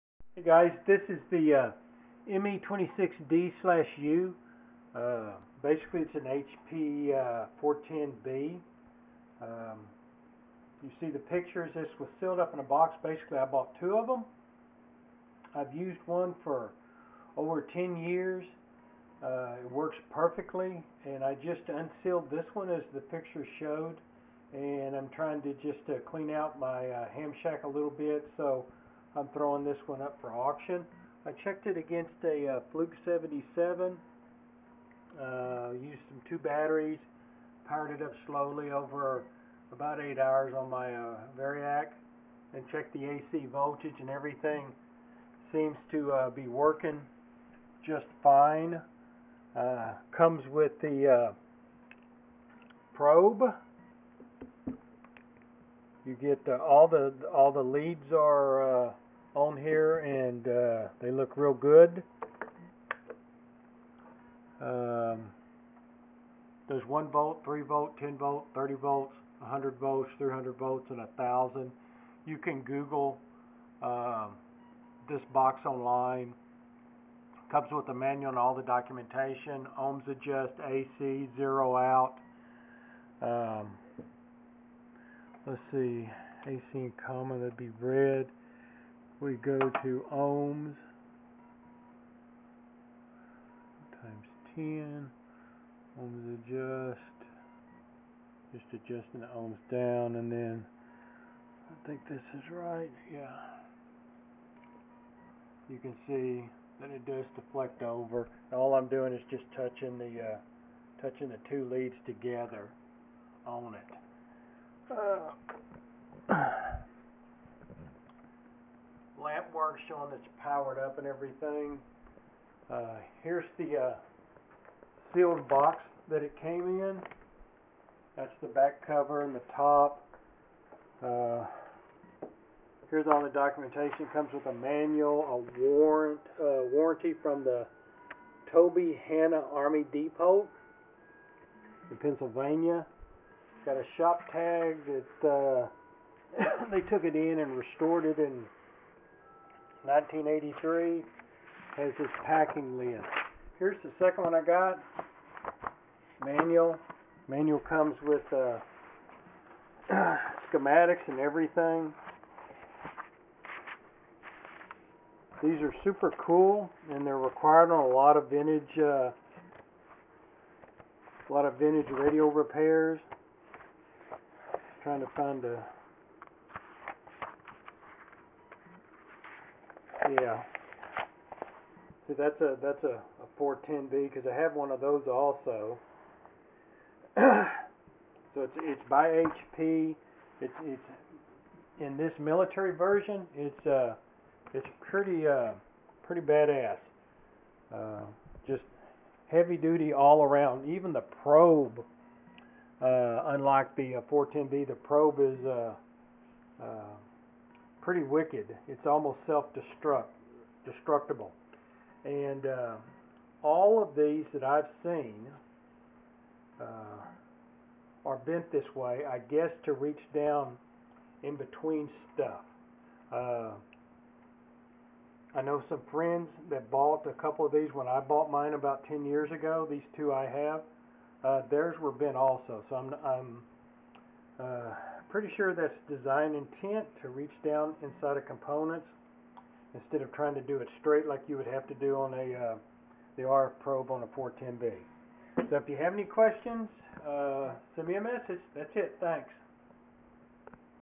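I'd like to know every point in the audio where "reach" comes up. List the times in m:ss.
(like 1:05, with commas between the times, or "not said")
3:39, 3:57.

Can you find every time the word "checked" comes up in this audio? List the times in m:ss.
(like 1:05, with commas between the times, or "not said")
0:31, 0:42.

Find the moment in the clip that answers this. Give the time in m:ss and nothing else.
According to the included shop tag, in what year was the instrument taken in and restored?
2:29.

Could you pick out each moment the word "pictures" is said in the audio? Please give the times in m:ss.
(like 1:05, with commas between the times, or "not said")
0:11, 0:23.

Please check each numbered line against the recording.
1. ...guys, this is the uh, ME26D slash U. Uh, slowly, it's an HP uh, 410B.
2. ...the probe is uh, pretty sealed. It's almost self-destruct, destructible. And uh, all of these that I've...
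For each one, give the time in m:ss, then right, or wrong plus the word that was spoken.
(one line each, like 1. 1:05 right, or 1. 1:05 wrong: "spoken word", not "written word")
1. 0:00 wrong: "basically", not "slowly"
2. 3:24 wrong: "wicked", not "sealed".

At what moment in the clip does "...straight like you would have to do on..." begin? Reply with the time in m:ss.
4:00.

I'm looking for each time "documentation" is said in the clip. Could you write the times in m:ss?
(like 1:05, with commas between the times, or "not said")
1:18, 2:13.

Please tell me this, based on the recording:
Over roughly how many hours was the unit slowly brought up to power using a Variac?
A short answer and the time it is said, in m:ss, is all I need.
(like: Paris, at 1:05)
8, at 0:40.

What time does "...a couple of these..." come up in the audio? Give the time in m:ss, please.
3:47.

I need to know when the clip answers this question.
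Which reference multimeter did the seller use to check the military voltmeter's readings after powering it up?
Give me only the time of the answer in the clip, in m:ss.
0:32.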